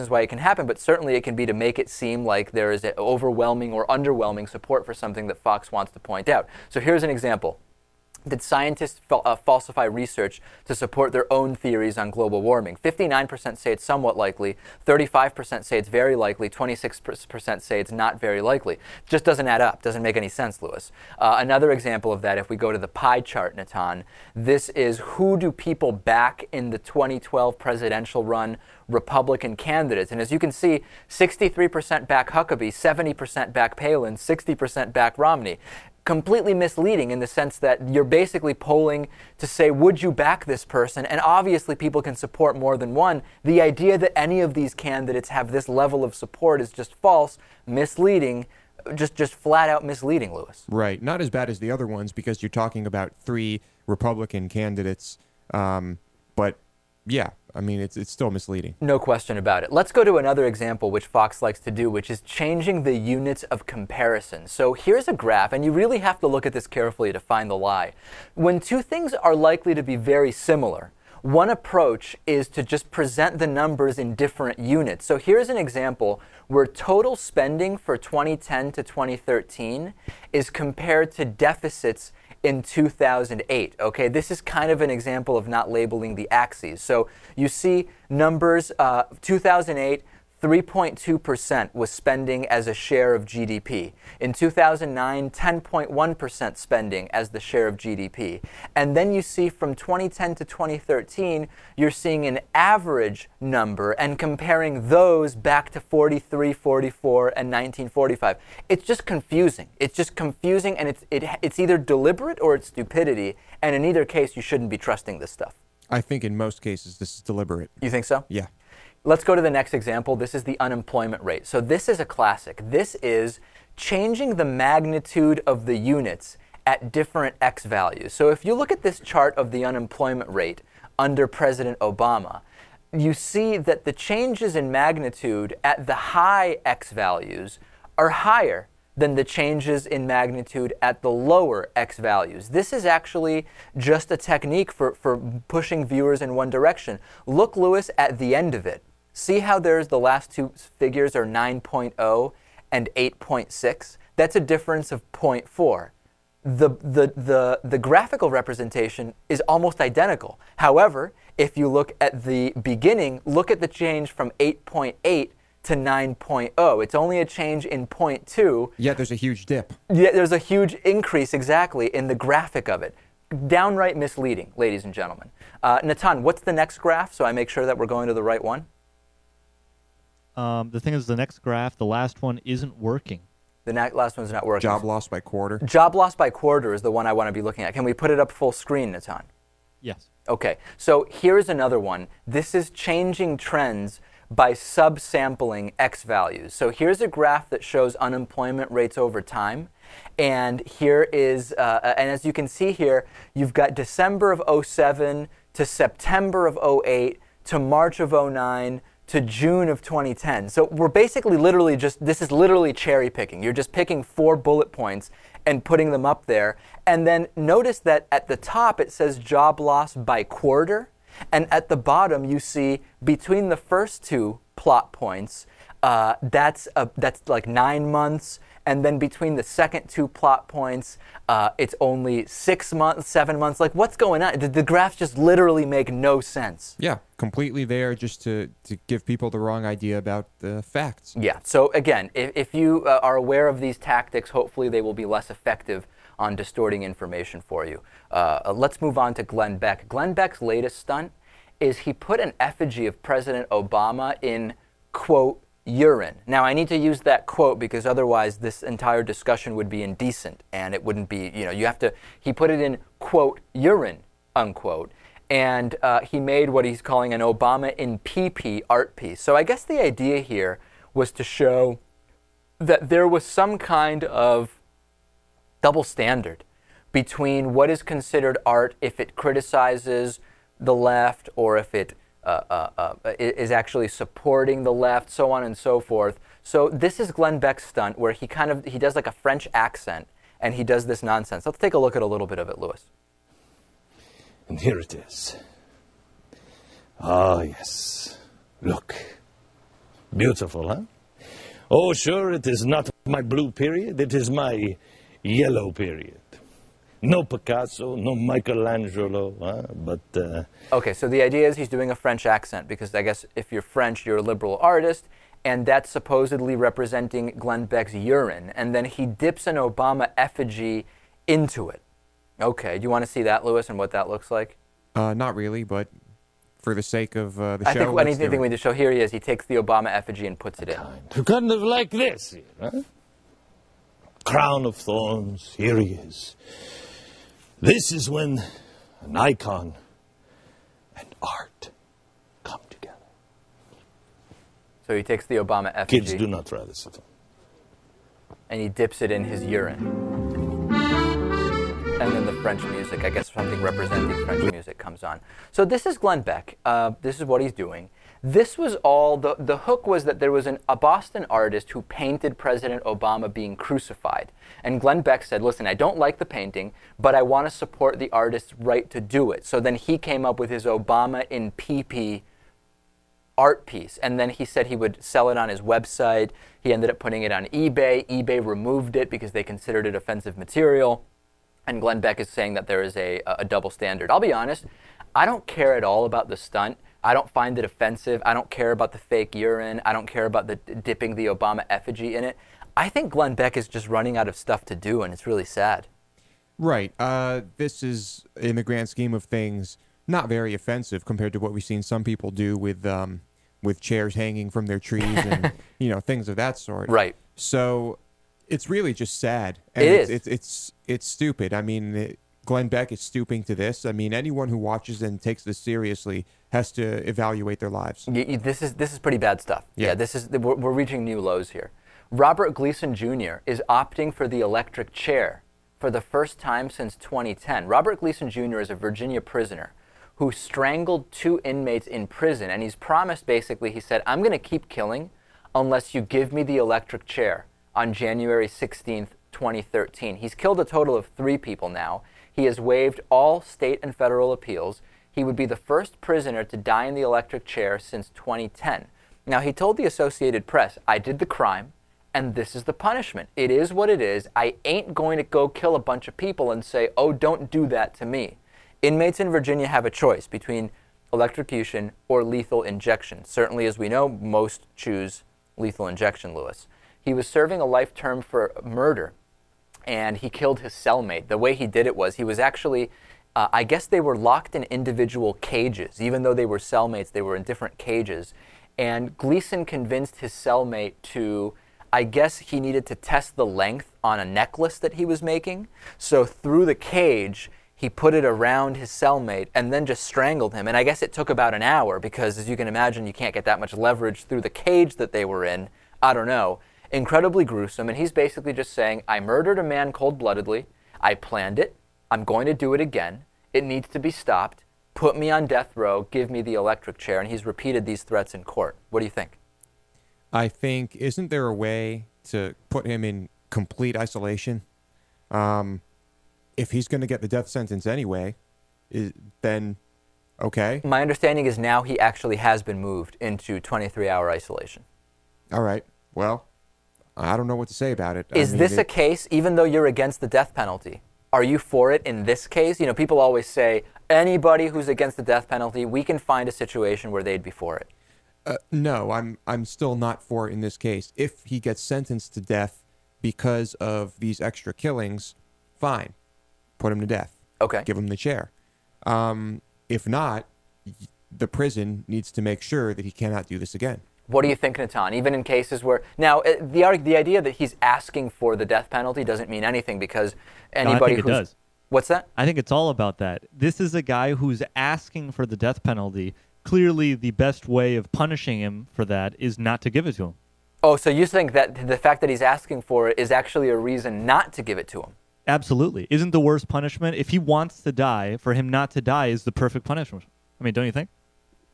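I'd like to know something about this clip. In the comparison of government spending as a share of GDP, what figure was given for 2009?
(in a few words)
10.1%.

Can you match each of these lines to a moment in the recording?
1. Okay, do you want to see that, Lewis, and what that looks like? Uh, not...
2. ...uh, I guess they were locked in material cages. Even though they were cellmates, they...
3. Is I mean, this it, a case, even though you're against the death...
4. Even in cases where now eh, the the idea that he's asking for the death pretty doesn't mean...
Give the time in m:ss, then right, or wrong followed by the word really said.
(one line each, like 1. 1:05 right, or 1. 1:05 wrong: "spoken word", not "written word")
1. 5:22 right
2. 7:53 wrong: "individual", not "material"
3. 8:48 right
4. 9:15 wrong: "penalty", not "pretty".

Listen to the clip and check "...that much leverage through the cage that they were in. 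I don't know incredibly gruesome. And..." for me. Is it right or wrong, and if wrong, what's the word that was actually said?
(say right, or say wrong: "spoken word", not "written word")
right.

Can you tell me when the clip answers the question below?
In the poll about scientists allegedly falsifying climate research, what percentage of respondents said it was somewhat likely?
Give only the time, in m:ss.
0:12.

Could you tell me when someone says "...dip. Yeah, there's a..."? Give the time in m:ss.
2:49.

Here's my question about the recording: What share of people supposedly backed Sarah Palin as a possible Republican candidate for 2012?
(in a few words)
70%.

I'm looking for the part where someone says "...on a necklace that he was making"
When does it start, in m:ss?
8:04.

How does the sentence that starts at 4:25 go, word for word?
And uh, he made what he's calling an Obama in PP art piece.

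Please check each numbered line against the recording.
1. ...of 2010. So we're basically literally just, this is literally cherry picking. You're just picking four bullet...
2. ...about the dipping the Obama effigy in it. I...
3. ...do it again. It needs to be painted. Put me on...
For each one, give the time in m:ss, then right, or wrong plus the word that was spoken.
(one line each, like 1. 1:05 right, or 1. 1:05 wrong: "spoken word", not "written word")
1. 3:29 right
2. 6:30 right
3. 8:22 wrong: "stopped", not "painted".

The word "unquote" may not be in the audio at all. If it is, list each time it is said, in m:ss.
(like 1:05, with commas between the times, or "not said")
4:24.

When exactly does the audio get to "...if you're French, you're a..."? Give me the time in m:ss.
5:13.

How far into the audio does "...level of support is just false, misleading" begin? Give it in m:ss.
0:45.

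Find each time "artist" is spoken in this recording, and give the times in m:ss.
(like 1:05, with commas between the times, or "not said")
5:14, 6:01, 6:08.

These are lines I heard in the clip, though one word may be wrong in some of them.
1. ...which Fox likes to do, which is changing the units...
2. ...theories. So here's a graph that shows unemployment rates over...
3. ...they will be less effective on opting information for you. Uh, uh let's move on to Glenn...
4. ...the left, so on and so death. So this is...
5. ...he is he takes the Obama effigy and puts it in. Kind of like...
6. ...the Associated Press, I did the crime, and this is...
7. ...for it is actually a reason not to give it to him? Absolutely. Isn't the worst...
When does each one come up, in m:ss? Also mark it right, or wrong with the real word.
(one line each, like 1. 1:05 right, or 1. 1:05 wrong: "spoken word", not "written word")
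1. 1:00 right
2. 3:16 wrong: "values", not "theories"
3. 4:04 wrong: "distorting", not "opting"
4. 4:44 wrong: "forth", not "death"
5. 5:28 right
6. 7:29 right
7. 9:32 right.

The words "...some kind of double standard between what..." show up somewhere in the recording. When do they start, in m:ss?
4:33.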